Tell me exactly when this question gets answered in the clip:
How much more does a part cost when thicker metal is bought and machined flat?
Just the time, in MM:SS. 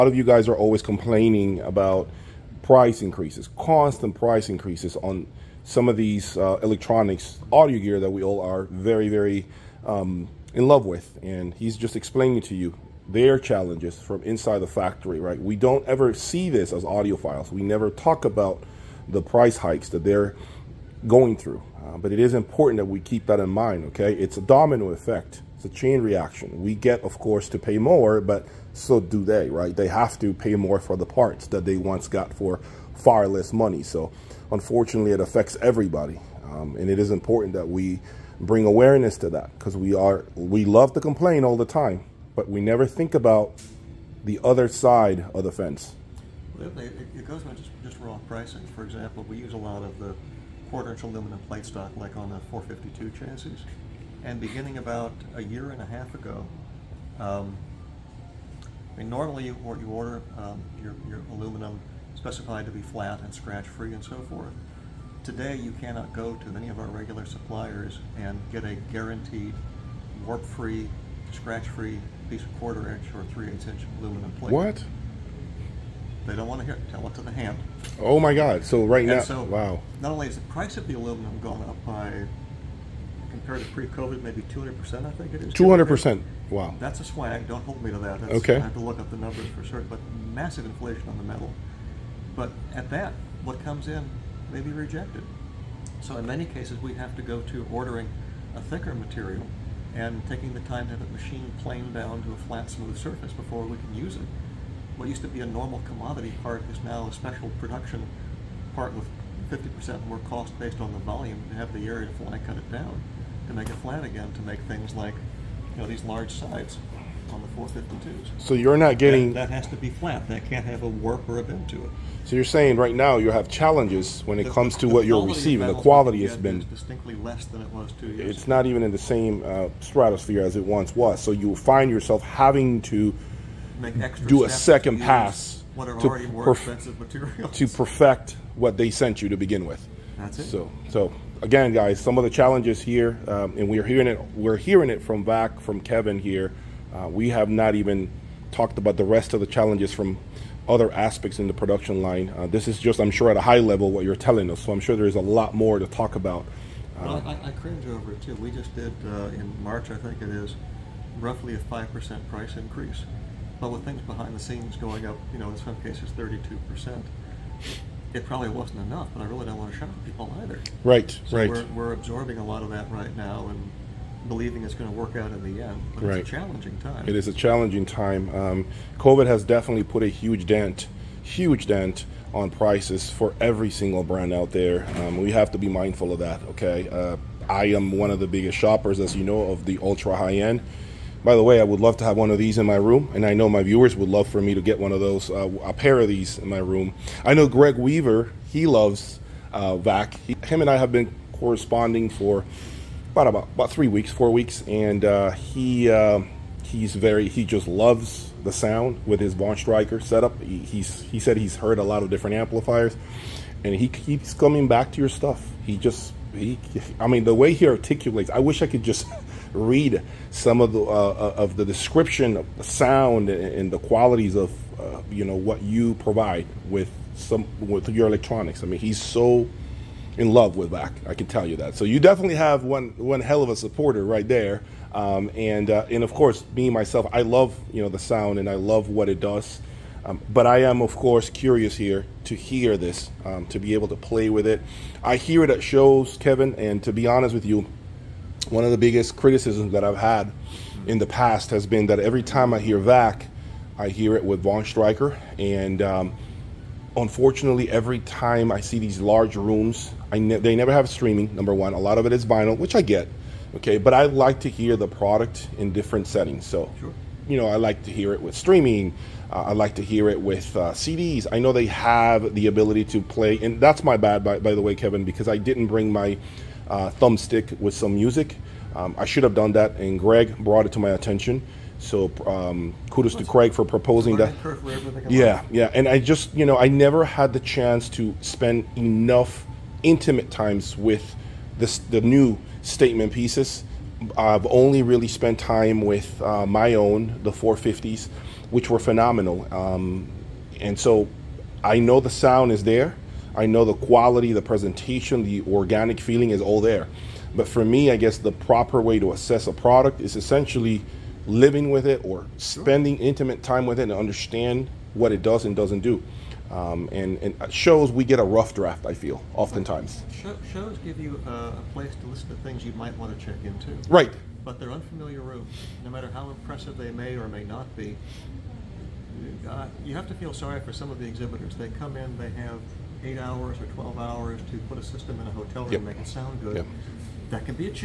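01:49.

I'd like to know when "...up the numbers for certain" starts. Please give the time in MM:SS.
01:28.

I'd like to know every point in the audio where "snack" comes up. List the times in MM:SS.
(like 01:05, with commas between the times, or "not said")
not said.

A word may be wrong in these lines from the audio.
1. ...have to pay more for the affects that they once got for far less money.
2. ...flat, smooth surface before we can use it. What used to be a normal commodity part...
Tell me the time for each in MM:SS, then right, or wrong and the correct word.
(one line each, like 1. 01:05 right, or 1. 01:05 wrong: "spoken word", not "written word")
1. 00:29 wrong: "parts", not "affects"
2. 01:42 right.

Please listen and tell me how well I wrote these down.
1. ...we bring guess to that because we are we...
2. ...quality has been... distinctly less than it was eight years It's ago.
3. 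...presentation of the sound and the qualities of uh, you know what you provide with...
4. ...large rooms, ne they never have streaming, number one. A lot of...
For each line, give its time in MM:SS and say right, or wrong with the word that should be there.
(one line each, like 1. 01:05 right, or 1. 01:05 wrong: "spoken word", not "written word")
1. 00:37 wrong: "awareness", not "guess"
2. 02:05 wrong: "two", not "eight"
3. 03:41 wrong: "description", not "presentation"
4. 04:19 right.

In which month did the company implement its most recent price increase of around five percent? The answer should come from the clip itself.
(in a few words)
March.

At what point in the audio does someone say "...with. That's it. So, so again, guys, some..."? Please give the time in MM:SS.
02:19.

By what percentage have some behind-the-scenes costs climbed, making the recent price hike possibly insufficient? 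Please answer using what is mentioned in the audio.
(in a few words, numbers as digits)
32%.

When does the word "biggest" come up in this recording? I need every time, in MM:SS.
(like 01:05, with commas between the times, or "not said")
03:08, 04:08.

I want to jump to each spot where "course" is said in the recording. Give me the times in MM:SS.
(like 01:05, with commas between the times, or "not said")
00:27, 03:56, 04:00.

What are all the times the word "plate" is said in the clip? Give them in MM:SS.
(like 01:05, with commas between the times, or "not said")
00:51, 01:14.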